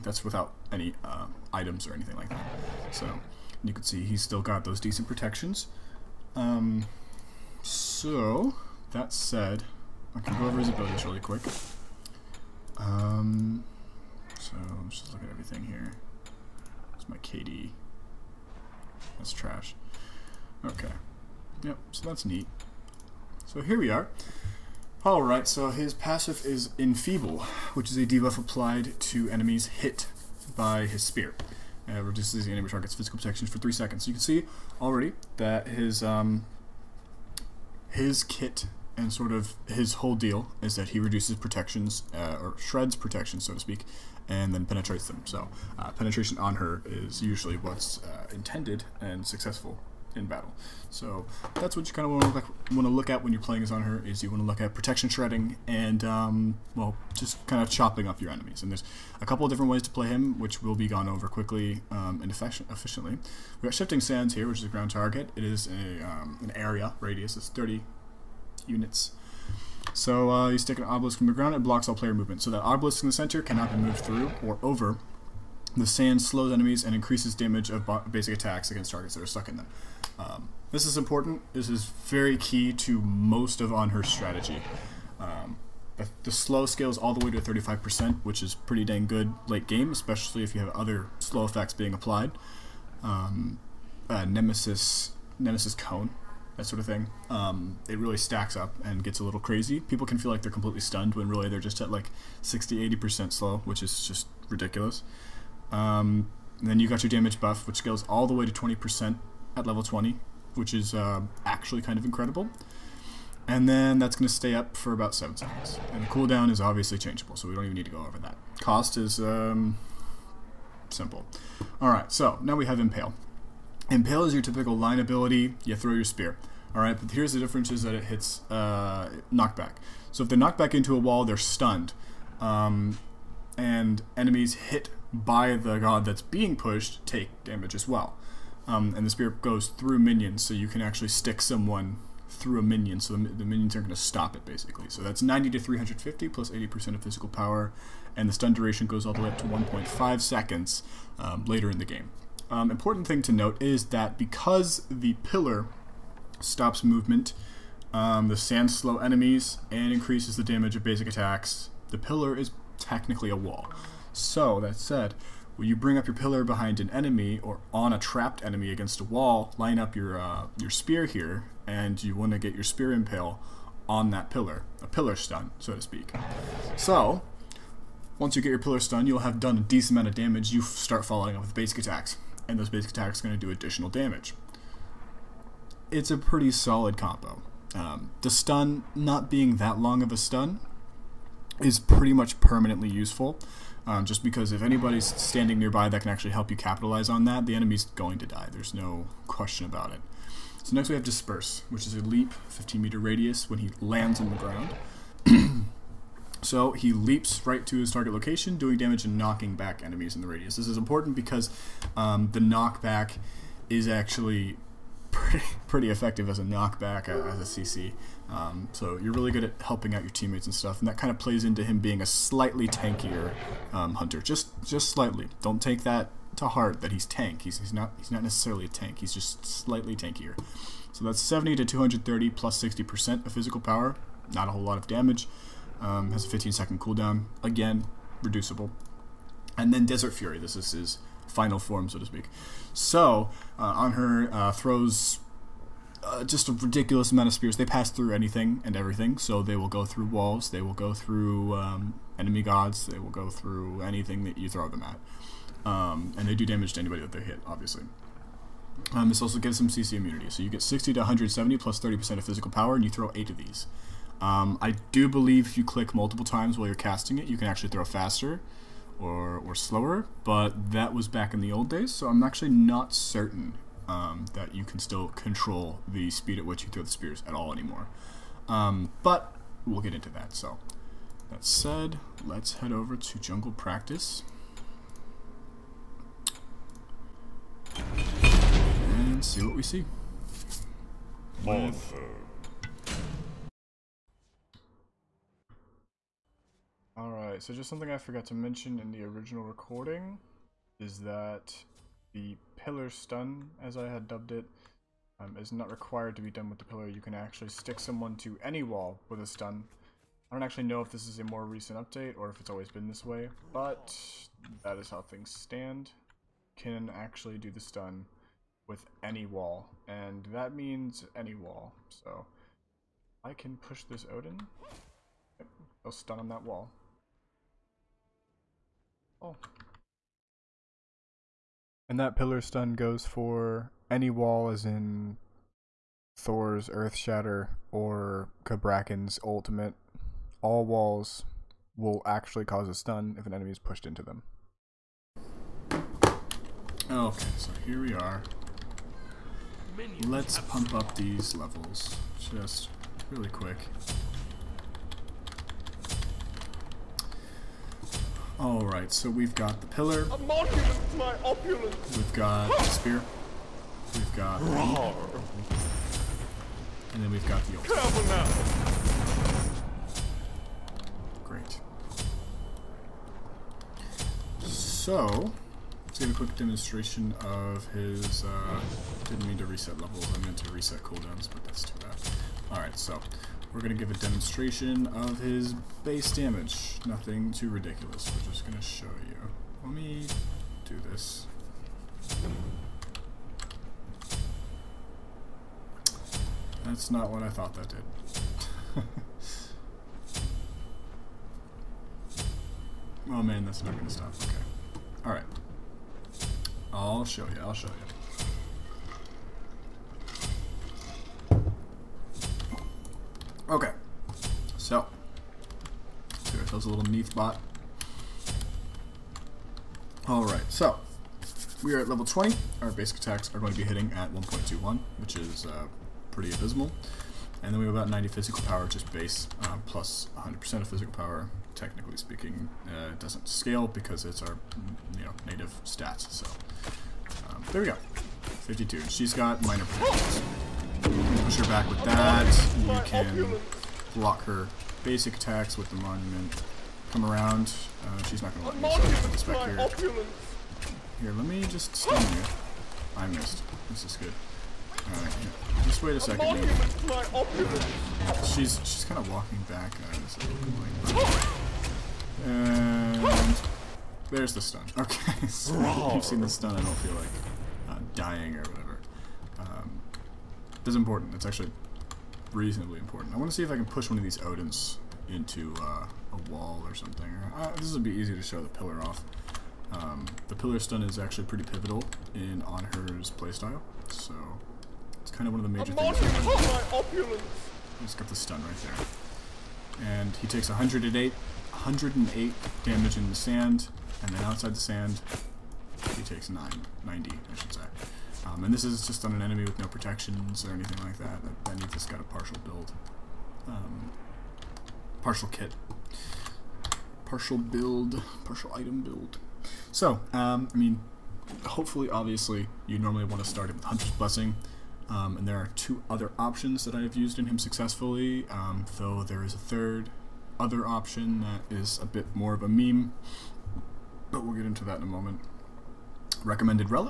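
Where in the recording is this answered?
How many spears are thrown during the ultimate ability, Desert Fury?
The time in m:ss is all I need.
4:23.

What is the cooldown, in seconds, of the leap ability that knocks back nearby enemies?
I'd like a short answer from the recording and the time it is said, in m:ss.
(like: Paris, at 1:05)
15, at 3:56.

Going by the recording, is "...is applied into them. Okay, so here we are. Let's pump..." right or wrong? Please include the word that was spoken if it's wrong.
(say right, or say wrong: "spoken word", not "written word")
wrong: "pushed", not "applied".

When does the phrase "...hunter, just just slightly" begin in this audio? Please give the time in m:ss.
3:43.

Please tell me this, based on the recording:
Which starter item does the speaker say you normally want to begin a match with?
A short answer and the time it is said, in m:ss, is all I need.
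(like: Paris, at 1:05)
Hunter's Blessing, at 8:33.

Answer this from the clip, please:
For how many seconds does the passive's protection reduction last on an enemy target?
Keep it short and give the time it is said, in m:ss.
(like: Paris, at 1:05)
3, at 0:33.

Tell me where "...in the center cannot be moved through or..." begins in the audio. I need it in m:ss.
1:13.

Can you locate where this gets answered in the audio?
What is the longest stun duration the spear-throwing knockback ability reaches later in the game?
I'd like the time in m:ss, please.
2:29.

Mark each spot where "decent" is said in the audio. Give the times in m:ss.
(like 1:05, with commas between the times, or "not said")
0:04, 2:59.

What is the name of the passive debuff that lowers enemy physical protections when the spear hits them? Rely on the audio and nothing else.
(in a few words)
Enfeeble.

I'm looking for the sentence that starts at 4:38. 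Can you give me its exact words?
Um, but we'll get into that, so that said, let's head over to jungle practice.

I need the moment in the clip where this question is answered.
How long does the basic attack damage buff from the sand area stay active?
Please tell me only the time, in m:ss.
1:54.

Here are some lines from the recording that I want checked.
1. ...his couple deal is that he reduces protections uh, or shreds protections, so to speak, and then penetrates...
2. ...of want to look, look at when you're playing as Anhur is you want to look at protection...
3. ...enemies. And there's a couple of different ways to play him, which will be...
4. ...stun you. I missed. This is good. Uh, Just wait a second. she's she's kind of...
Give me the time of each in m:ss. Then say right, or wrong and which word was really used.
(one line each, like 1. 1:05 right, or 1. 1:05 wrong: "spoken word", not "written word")
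1. 0:39 wrong: "whole", not "couple"
2. 0:52 right
3. 0:58 right
4. 7:31 right.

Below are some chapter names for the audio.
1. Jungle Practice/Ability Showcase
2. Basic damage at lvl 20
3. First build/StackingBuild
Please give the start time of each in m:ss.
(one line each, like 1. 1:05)
1. 5:46
2. 7:15
3. 8:27.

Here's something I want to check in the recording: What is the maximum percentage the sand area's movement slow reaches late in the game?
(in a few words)
35%.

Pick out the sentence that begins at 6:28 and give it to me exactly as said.
We're just going to show you.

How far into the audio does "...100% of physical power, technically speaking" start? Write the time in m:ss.
7:10.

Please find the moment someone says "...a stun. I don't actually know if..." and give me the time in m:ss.
5:09.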